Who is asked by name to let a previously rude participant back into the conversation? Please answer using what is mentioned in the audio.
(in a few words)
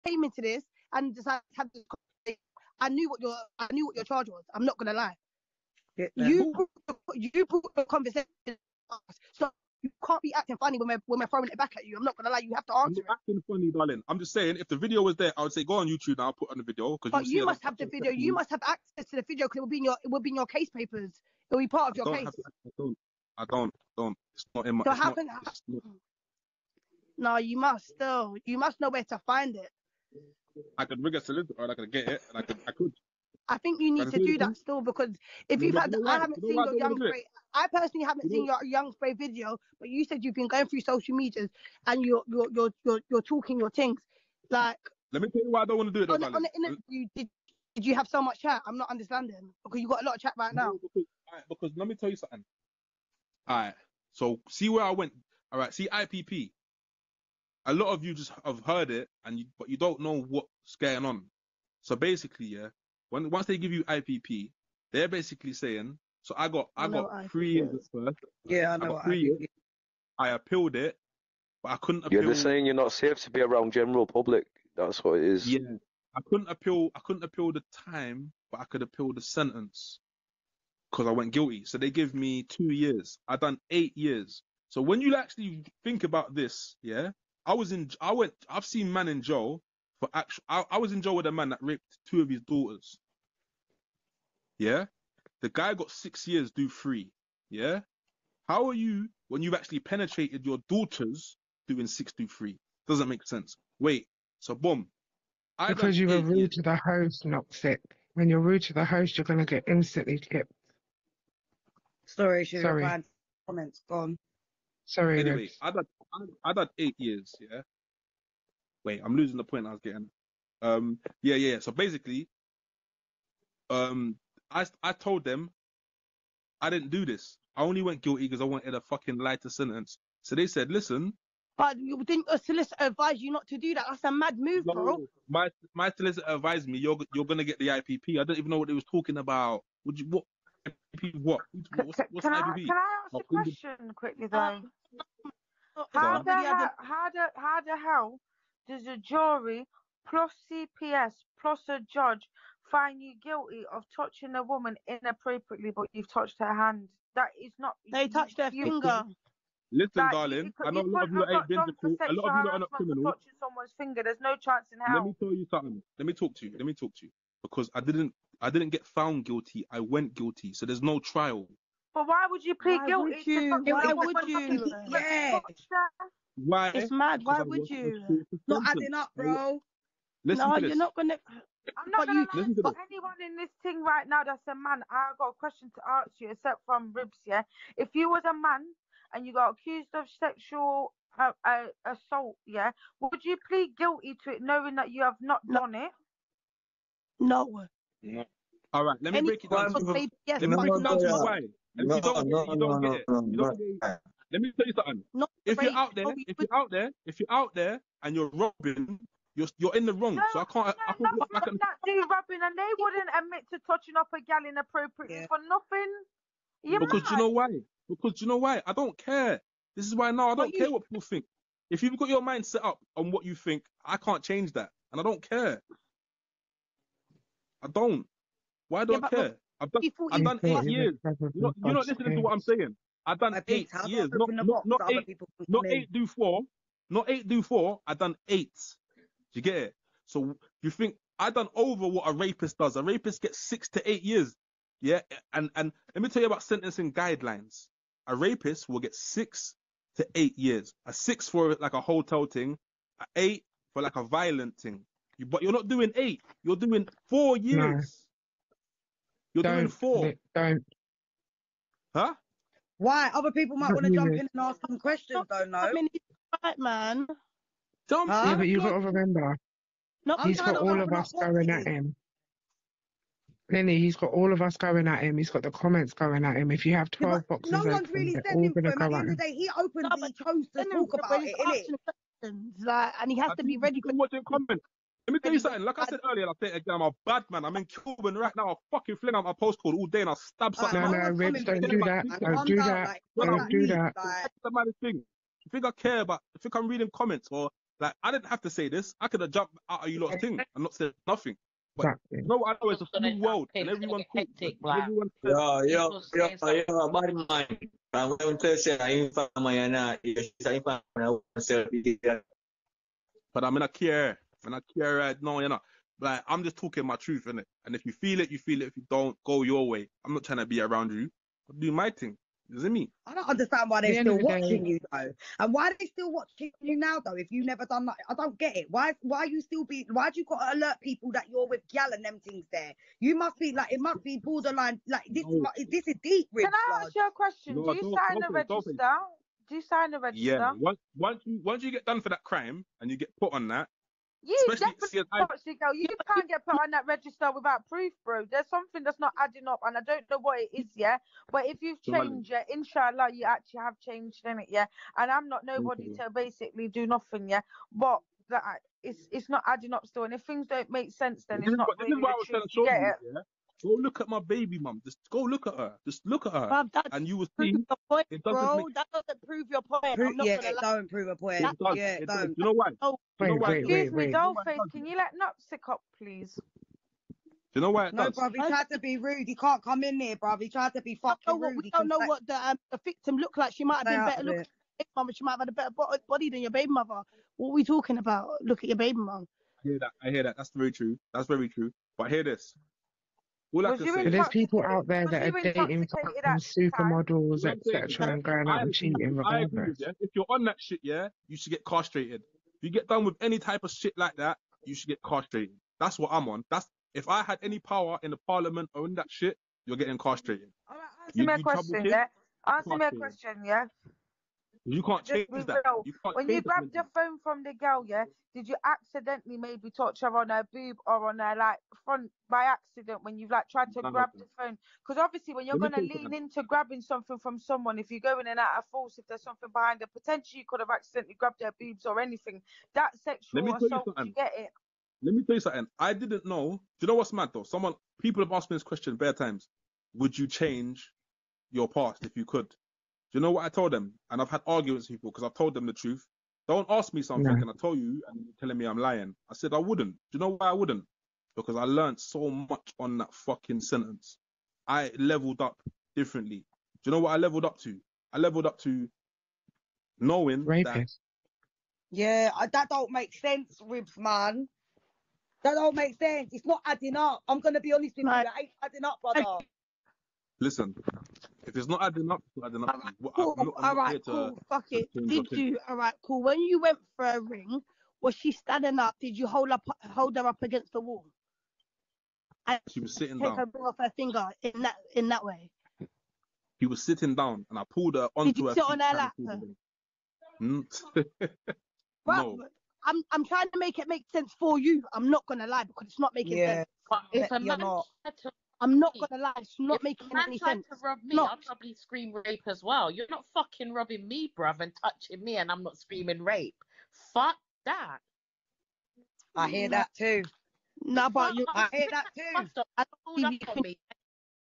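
Goldface.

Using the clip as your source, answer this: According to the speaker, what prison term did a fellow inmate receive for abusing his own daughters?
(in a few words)
6 years.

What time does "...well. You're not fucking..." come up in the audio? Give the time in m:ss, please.
8:22.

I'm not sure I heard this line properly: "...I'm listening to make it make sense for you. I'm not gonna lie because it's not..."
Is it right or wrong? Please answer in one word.
wrong.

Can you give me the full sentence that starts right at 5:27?
If you never done that, I don't get it.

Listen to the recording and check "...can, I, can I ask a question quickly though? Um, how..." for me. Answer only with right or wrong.
right.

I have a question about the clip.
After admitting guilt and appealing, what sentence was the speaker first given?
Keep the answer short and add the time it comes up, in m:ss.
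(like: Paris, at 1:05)
2 years, at 1:22.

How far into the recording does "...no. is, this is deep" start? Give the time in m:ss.
5:35.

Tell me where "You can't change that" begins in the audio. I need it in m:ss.
6:54.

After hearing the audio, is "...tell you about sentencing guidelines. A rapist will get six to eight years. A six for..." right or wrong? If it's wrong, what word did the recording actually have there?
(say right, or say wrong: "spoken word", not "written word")
right.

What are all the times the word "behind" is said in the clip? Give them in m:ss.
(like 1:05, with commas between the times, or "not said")
7:09.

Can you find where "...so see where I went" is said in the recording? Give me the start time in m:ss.
0:54.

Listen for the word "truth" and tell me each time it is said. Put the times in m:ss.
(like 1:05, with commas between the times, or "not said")
5:16, 7:25.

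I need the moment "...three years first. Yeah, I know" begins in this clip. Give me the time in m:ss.
1:07.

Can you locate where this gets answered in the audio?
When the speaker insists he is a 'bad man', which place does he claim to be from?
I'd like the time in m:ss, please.
5:09.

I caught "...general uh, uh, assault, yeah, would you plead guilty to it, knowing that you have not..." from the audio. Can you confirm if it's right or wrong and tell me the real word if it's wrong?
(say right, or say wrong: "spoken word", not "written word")
wrong: "sexual", not "general".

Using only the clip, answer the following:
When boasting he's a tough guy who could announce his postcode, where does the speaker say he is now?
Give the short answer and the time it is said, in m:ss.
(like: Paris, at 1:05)
Cuban, at 4:47.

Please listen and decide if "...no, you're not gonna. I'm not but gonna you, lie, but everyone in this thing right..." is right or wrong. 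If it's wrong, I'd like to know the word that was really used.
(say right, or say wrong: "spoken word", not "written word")
wrong: "anyone", not "everyone".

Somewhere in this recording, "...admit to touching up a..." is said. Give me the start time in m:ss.
3:33.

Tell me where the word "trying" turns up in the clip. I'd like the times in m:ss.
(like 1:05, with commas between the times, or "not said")
5:20, 6:02, 8:13.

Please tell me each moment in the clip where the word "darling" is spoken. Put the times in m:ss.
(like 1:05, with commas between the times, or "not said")
0:13, 2:40.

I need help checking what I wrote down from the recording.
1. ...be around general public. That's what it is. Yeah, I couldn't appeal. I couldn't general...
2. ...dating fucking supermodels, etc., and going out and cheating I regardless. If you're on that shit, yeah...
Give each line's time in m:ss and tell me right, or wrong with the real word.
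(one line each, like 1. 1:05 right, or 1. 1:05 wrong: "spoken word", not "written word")
1. 1:13 wrong: "appeal", not "general"
2. 6:35 right.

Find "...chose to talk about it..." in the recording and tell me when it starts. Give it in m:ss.
4:40.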